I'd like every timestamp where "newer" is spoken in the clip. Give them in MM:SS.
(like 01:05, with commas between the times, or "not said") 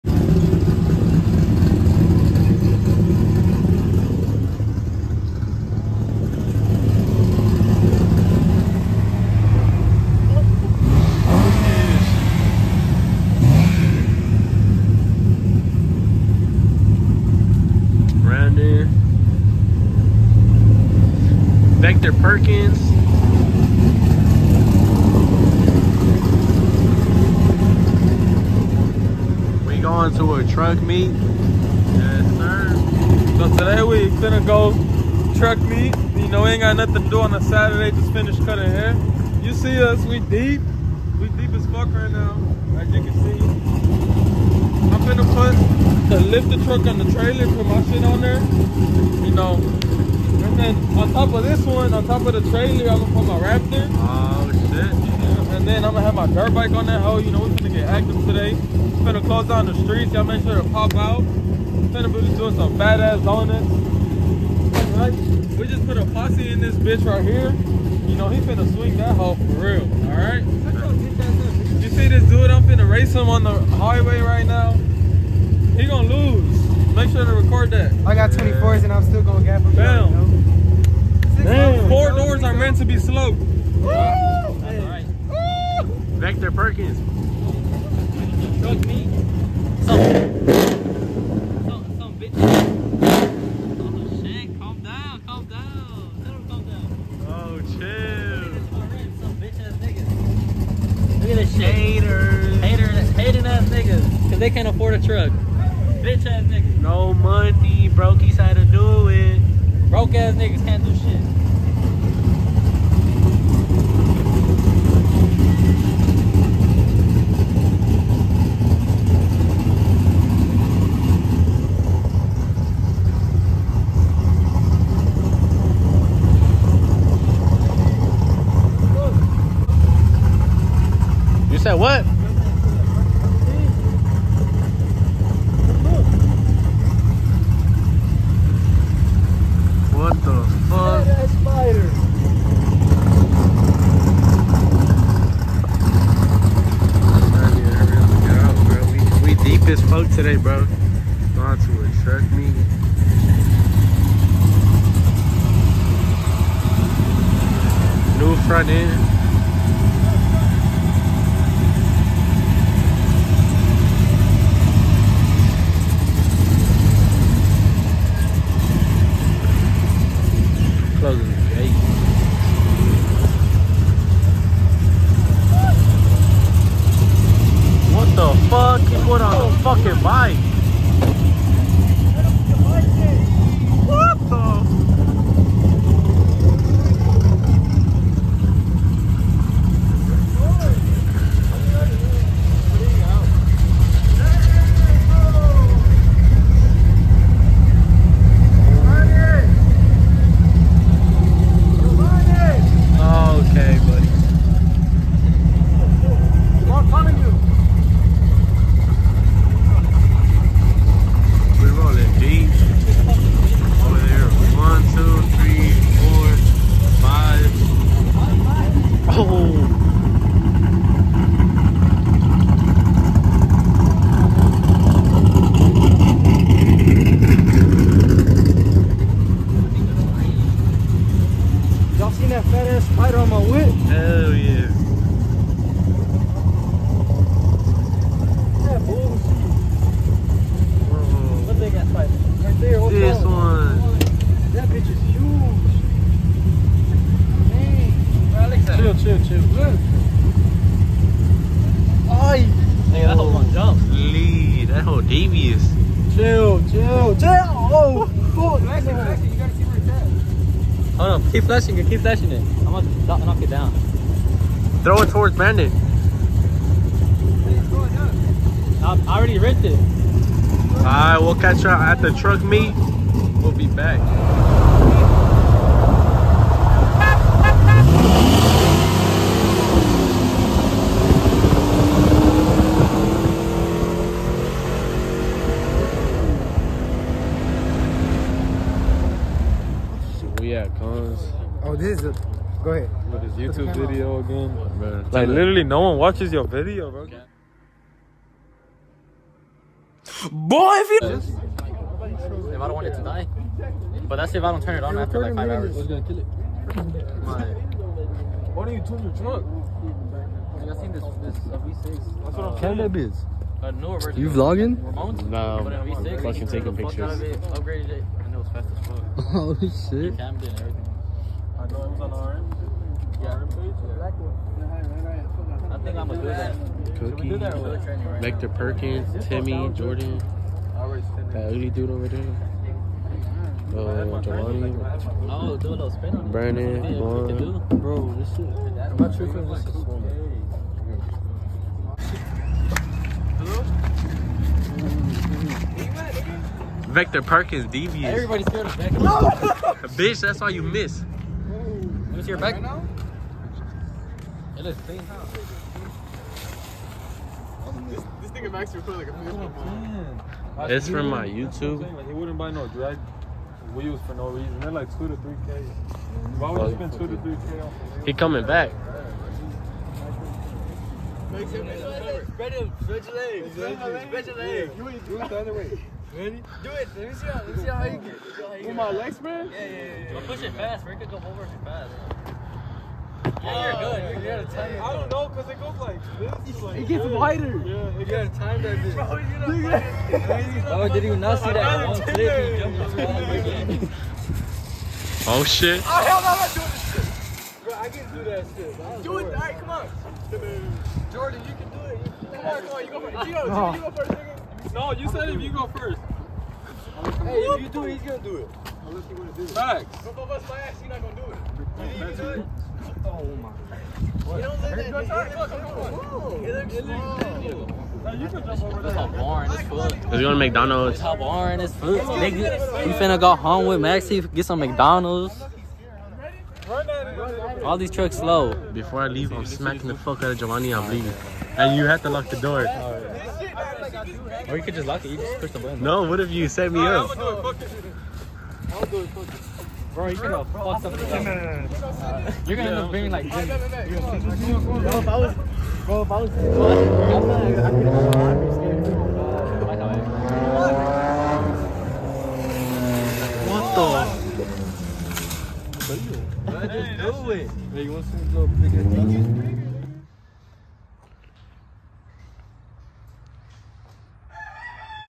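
05:13.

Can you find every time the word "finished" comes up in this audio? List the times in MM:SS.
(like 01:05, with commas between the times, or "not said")
00:38.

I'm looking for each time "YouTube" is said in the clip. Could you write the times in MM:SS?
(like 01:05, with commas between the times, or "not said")
04:53, 06:01.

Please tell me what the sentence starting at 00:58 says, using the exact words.
We're gonna close down the streets.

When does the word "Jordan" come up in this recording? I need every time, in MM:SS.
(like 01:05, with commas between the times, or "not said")
05:29, 06:41.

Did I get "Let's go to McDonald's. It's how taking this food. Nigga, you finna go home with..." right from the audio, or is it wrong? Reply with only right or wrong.
wrong.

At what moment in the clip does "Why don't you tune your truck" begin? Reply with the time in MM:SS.
05:08.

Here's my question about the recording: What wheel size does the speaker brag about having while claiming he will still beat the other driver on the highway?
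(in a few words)
24s.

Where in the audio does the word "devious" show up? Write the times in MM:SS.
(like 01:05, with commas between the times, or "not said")
04:15, 05:47.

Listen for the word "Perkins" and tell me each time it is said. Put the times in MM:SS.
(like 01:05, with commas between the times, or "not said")
00:22, 01:26, 05:28, 05:47.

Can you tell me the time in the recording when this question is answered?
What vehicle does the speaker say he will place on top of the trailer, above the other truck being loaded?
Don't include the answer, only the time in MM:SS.
00:53.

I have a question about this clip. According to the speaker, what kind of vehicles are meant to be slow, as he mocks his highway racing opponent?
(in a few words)
Four doors.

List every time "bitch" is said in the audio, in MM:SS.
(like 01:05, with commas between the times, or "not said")
01:06, 01:46, 04:04, 05:12, 05:49, 06:28.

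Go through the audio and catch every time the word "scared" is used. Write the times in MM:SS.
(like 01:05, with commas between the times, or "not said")
05:48, 07:28.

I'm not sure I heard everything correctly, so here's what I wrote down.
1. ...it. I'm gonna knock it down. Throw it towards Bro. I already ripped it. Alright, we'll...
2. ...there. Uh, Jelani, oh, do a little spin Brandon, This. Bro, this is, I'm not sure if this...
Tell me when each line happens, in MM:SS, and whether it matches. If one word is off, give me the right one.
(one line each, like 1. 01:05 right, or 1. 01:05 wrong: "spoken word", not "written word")
1. 04:22 wrong: "Brandon", not "Bro"
2. 05:32 wrong: "Vaughn", not "This".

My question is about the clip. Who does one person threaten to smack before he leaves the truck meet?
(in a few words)
Giovanni.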